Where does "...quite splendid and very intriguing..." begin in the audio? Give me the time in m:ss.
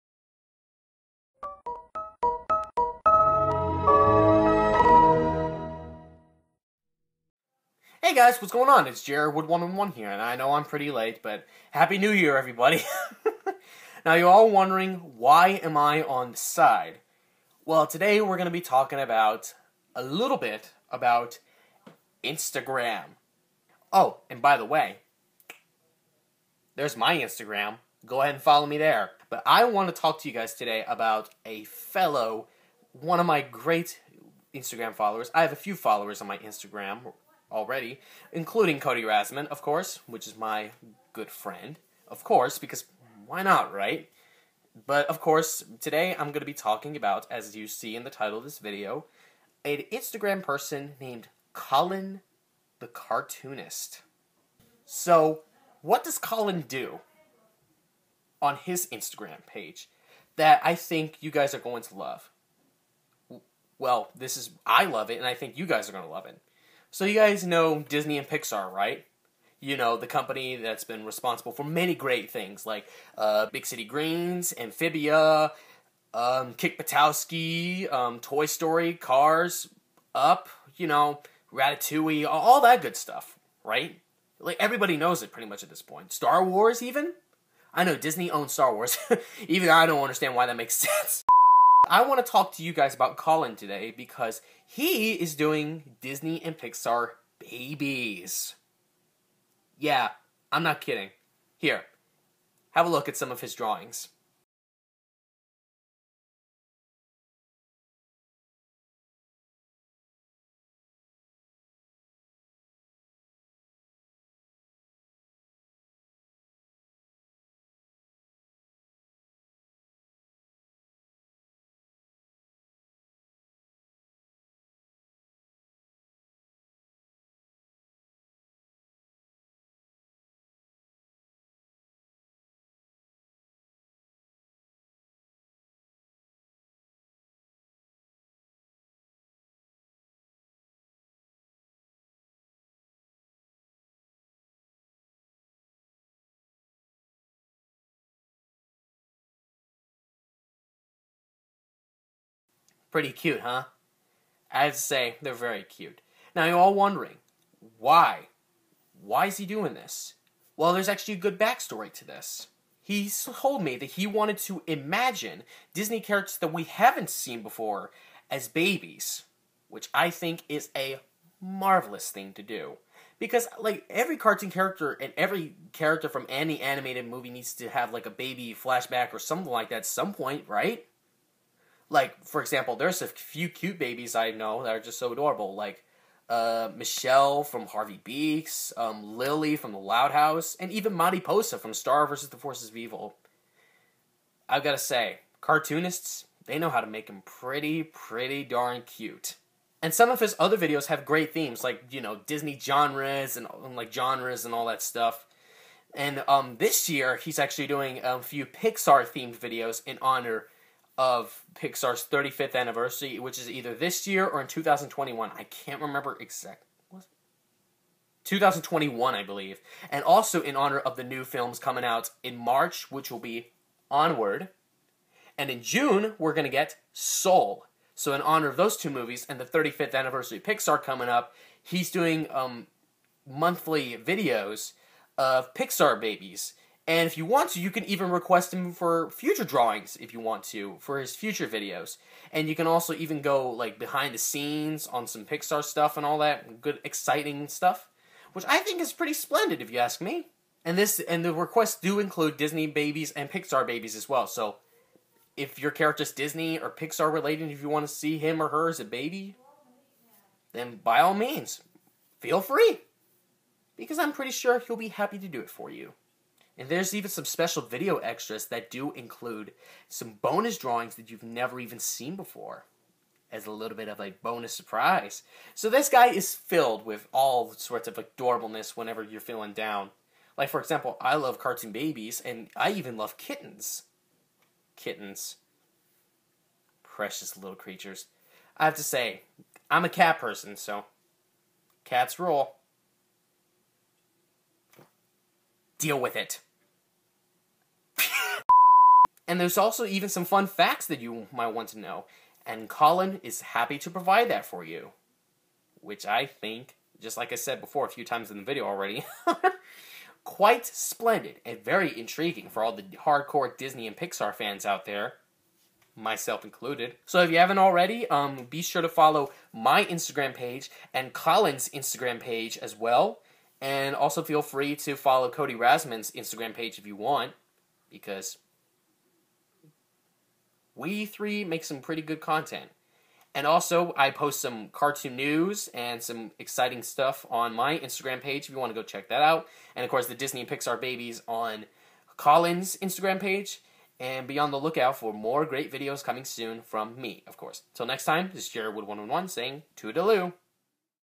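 5:10.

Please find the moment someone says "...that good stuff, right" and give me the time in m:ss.
1:22.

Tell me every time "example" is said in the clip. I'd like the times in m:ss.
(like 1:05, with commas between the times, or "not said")
3:02, 4:40.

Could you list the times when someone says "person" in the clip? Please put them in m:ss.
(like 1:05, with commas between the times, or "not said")
0:50, 4:50.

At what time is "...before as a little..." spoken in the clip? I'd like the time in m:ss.
4:32.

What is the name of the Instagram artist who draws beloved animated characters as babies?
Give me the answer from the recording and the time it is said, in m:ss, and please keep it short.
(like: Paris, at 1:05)
Colin the Cartoonist, at 0:51.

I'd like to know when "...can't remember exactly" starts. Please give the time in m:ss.
3:35.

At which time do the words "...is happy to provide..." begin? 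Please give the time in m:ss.
5:03.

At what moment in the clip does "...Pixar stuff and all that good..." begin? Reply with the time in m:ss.
4:05.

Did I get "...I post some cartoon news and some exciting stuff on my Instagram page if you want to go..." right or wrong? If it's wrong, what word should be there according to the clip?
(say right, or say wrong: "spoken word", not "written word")
right.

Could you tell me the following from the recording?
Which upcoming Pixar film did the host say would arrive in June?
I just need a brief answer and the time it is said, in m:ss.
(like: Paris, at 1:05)
Soul, at 3:46.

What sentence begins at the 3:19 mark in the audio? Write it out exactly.
And some of his other videos have great themes, like, you know, Disney genres and, and like genres and all that stuff.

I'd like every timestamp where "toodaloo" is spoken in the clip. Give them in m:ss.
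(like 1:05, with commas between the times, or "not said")
5:49.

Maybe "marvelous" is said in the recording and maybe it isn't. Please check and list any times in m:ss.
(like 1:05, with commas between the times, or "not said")
2:51.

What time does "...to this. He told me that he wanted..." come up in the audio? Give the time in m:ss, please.
2:41.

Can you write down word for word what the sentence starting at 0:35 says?
I have a few followers on my Instagram already, including Cody Rasman, of course, which is my good friend.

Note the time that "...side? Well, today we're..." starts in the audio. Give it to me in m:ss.
0:16.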